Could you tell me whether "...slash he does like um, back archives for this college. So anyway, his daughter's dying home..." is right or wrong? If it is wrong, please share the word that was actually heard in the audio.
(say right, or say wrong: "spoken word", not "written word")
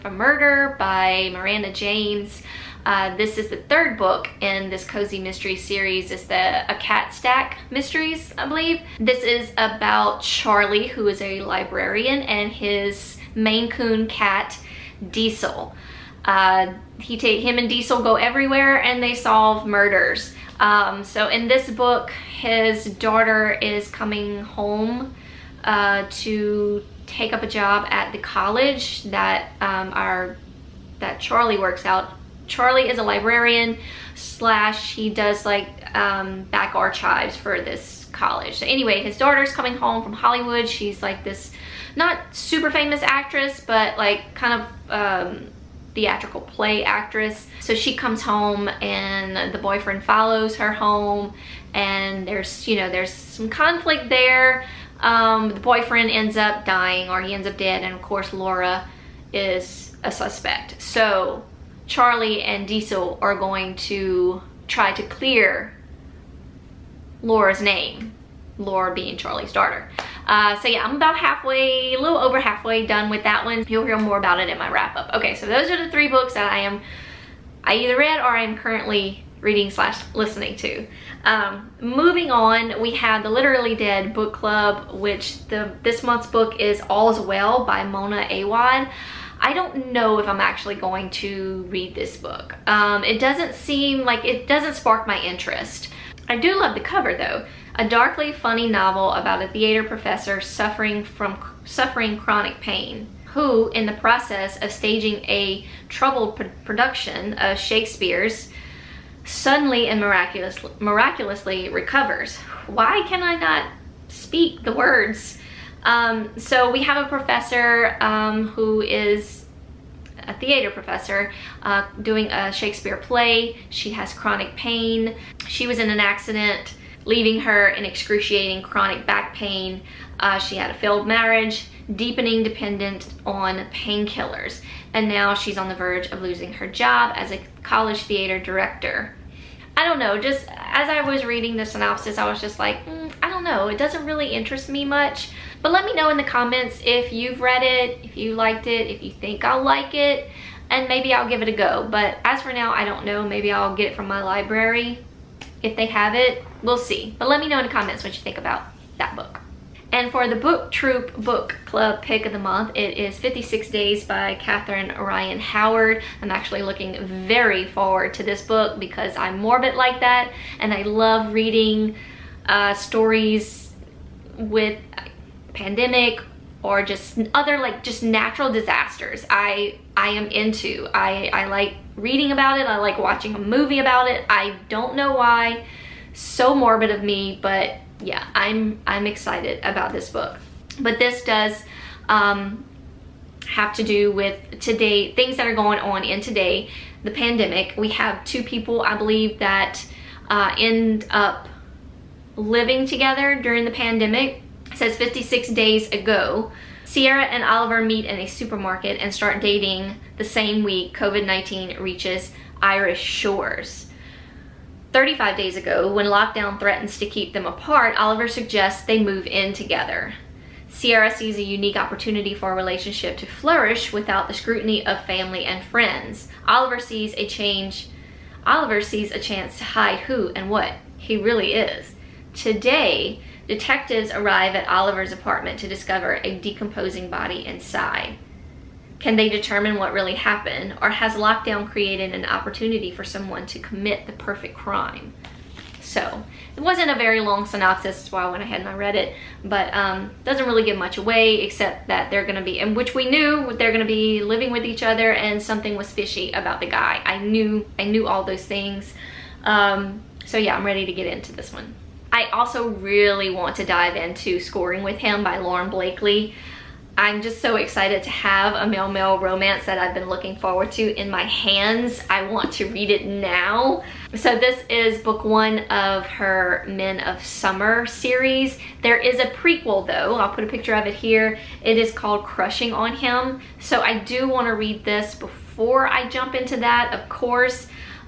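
wrong: "coming", not "dying".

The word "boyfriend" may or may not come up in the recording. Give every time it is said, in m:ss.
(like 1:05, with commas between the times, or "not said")
0:49, 0:55.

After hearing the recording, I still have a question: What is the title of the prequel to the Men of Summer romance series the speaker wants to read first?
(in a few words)
Crushing on Him.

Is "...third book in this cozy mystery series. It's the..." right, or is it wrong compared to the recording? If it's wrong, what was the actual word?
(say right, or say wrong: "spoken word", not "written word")
right.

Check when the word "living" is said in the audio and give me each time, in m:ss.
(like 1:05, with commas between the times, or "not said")
3:22, 4:14.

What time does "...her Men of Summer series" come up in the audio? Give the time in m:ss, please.
4:36.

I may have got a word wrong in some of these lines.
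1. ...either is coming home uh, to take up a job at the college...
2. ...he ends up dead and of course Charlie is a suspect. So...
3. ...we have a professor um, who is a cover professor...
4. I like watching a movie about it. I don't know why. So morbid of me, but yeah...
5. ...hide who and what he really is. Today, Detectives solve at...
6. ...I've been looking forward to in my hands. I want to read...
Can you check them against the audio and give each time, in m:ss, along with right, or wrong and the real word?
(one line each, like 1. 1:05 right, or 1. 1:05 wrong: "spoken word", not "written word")
1. 0:22 wrong: "daughter", not "either"
2. 0:57 wrong: "Laura", not "Charlie"
3. 1:56 wrong: "theater", not "cover"
4. 3:02 right
5. 3:49 wrong: "arrive", not "solve"
6. 4:29 right.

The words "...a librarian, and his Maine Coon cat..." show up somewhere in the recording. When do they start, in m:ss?
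0:11.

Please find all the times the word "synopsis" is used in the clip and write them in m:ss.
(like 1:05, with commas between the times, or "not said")
2:21, 4:07.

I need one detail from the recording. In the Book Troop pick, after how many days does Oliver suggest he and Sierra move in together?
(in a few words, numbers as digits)
35.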